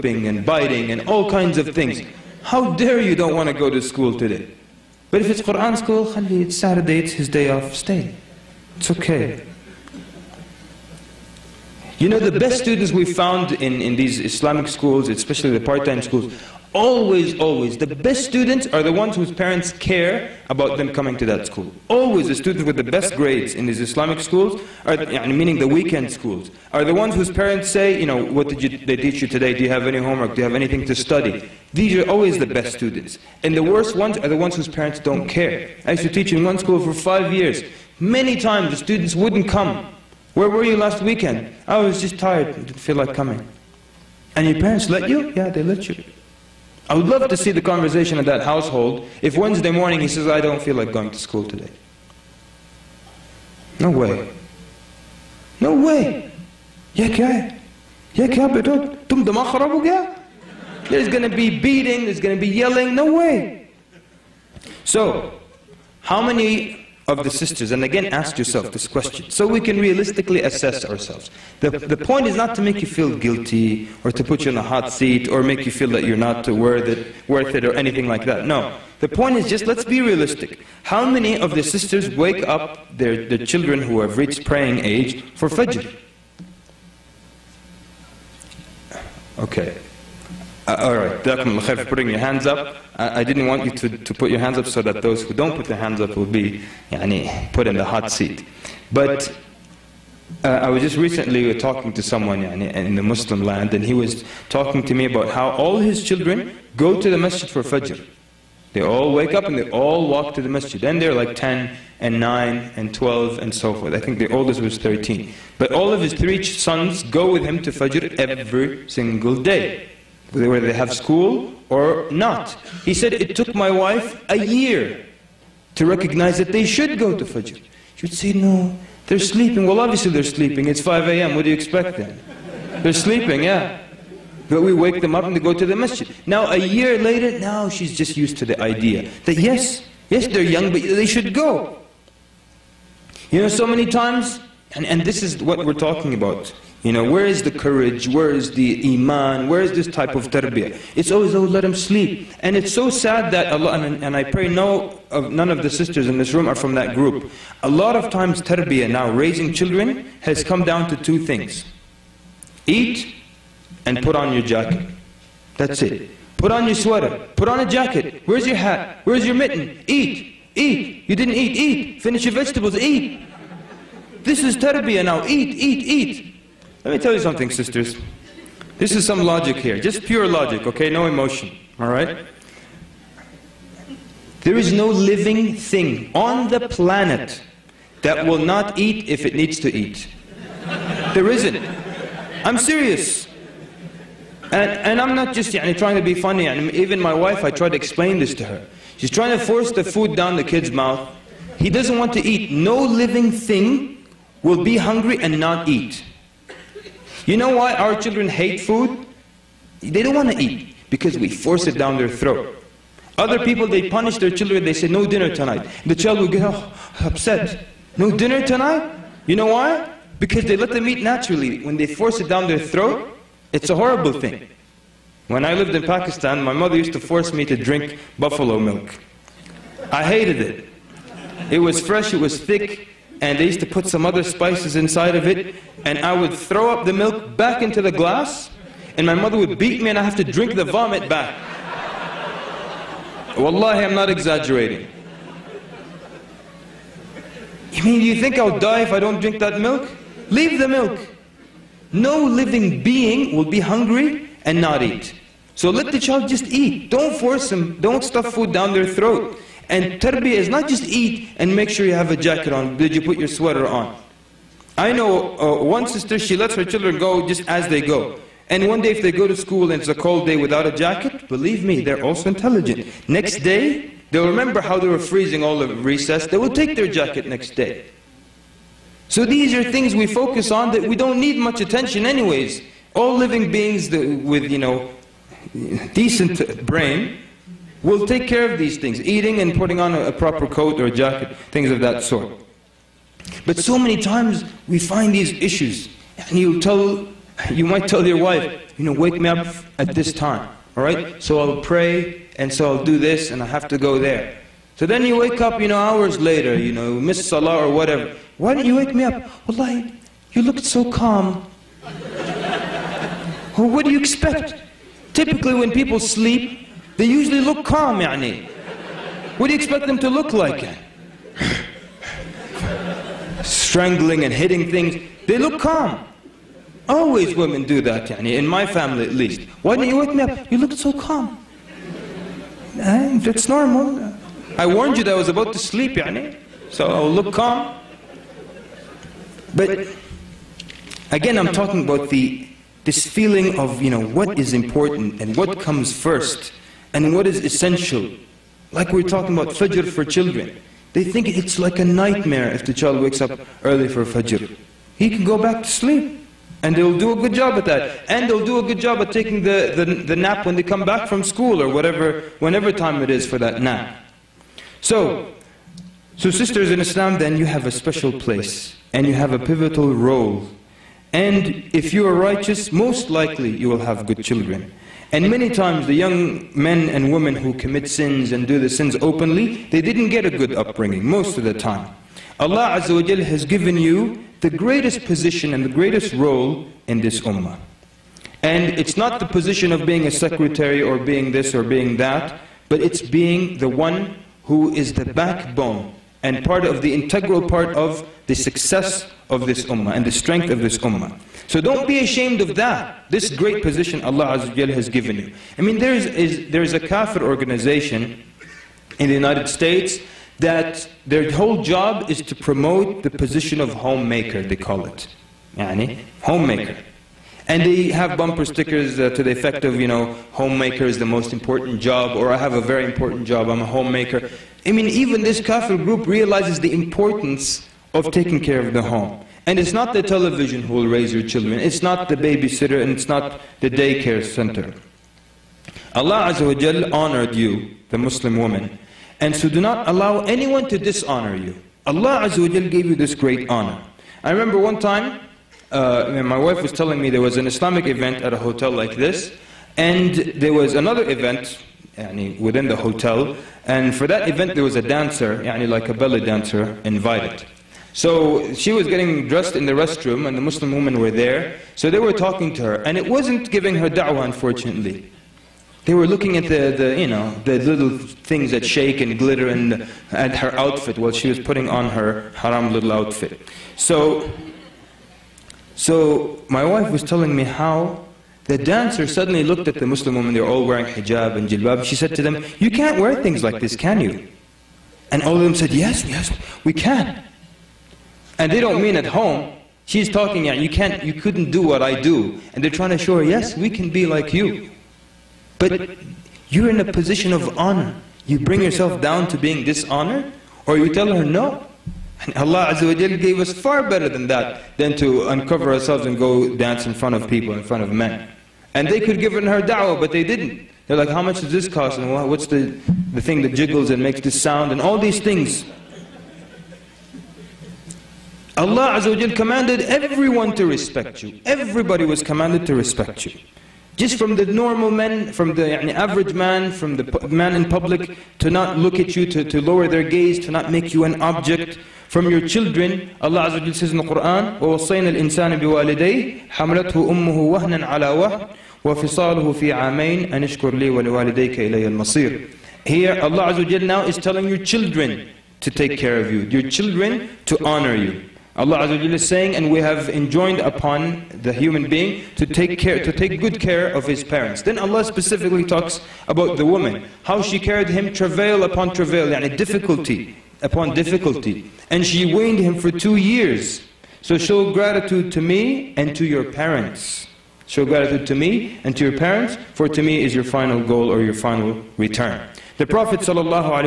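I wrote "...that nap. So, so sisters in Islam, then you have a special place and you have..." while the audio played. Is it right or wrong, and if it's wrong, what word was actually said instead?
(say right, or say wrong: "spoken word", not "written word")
right.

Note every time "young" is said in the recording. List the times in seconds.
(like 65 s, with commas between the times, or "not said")
140 s, 375 s.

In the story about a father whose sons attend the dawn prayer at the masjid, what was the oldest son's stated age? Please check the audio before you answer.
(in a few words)
13.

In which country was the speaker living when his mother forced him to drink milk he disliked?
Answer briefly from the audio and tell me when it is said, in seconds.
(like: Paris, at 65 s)
Pakistan, at 225 s.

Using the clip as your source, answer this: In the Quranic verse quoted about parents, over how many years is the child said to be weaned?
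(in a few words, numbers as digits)
2.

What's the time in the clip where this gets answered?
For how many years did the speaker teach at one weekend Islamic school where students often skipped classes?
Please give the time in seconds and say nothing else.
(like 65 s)
36 s.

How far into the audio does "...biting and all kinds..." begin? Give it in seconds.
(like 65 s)
0 s.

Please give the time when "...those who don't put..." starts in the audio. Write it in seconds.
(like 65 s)
95 s.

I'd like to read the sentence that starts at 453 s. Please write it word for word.
And for that event, there was a dancer, يعني, like a belly dancer, invited.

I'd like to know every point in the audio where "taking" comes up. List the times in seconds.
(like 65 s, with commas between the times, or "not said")
359 s, 428 s.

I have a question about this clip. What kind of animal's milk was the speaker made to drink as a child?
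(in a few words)
Buffalo.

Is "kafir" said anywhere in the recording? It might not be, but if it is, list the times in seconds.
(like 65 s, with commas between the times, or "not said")
406 s, 425 s.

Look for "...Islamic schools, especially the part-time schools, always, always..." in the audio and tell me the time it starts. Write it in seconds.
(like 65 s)
14 s.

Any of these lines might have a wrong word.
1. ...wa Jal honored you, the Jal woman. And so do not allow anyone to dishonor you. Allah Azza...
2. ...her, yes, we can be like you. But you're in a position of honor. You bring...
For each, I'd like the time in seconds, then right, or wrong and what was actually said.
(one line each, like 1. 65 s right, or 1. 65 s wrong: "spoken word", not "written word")
1. 436 s wrong: "Muslim", not "Jal"
2. 493 s right.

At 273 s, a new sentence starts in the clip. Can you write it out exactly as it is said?
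Next day, they'll remember how they were freezing all of recess.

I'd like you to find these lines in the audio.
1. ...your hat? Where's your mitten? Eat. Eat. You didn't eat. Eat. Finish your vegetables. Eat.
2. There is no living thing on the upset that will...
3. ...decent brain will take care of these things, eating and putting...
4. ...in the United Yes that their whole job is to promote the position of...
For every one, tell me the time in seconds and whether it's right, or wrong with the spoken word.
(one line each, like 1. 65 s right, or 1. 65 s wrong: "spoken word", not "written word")
1. 168 s right
2. 184 s wrong: "planet", not "upset"
3. 285 s right
4. 408 s wrong: "States", not "Yes".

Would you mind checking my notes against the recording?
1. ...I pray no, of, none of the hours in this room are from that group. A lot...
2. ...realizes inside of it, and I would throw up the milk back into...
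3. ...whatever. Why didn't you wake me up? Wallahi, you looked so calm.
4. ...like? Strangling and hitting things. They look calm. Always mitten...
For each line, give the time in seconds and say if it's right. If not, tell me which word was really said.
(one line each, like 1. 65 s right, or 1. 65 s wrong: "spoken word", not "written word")
1. 154 s wrong: "sisters", not "hours"
2. 234 s wrong: "spices", not "realizes"
3. 307 s right
4. 320 s wrong: "women", not "mitten".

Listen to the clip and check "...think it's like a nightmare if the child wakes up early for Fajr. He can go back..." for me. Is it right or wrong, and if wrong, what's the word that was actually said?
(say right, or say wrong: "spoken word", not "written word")
right.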